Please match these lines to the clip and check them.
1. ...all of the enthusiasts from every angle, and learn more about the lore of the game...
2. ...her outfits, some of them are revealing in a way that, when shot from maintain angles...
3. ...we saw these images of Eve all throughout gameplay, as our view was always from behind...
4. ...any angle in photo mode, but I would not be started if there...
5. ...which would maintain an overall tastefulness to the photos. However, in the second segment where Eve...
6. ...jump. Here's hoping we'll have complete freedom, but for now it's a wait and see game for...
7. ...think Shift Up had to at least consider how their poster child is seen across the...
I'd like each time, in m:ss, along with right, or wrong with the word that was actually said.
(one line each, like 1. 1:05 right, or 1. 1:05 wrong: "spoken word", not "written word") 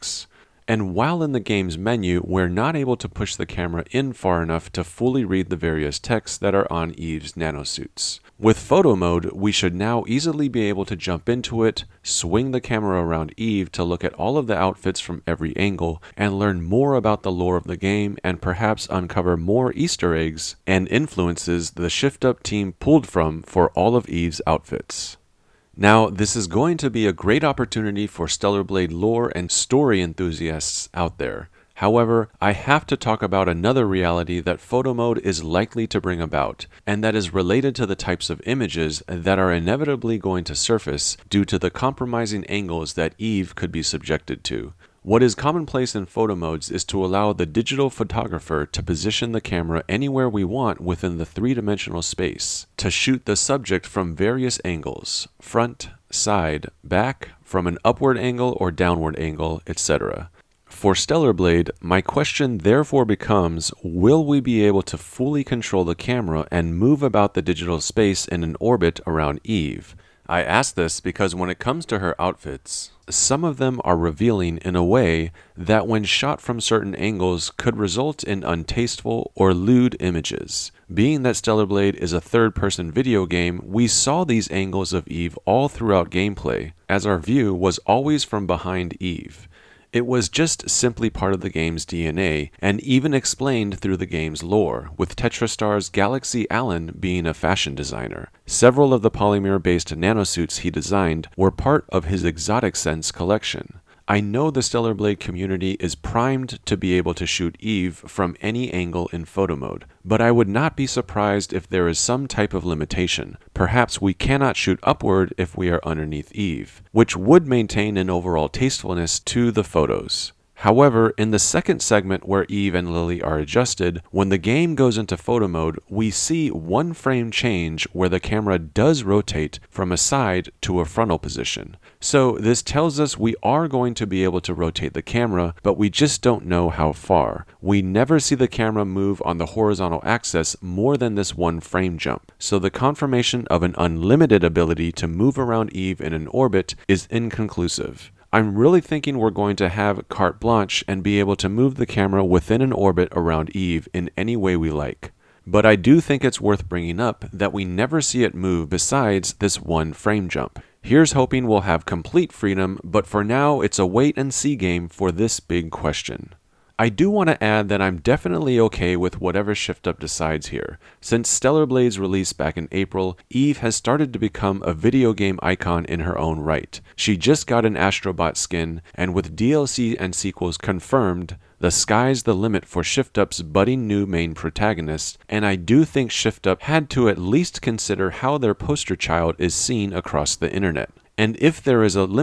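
1. 0:14 wrong: "outfits", not "enthusiasts"
2. 1:11 wrong: "certain", not "maintain"
3. 1:23 wrong: "angles", not "images"
4. 1:48 wrong: "surprised", not "started"
5. 1:56 right
6. 2:40 right
7. 3:05 right.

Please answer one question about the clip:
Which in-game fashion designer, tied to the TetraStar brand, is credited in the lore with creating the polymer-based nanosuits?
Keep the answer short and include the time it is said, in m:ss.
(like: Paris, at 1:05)
Galaxy Allen, at 1:35.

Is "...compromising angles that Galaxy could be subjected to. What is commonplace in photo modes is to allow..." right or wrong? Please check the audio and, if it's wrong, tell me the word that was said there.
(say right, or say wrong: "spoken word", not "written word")
wrong: "Eve", not "Galaxy".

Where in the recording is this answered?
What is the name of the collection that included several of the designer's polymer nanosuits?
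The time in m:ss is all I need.
1:42.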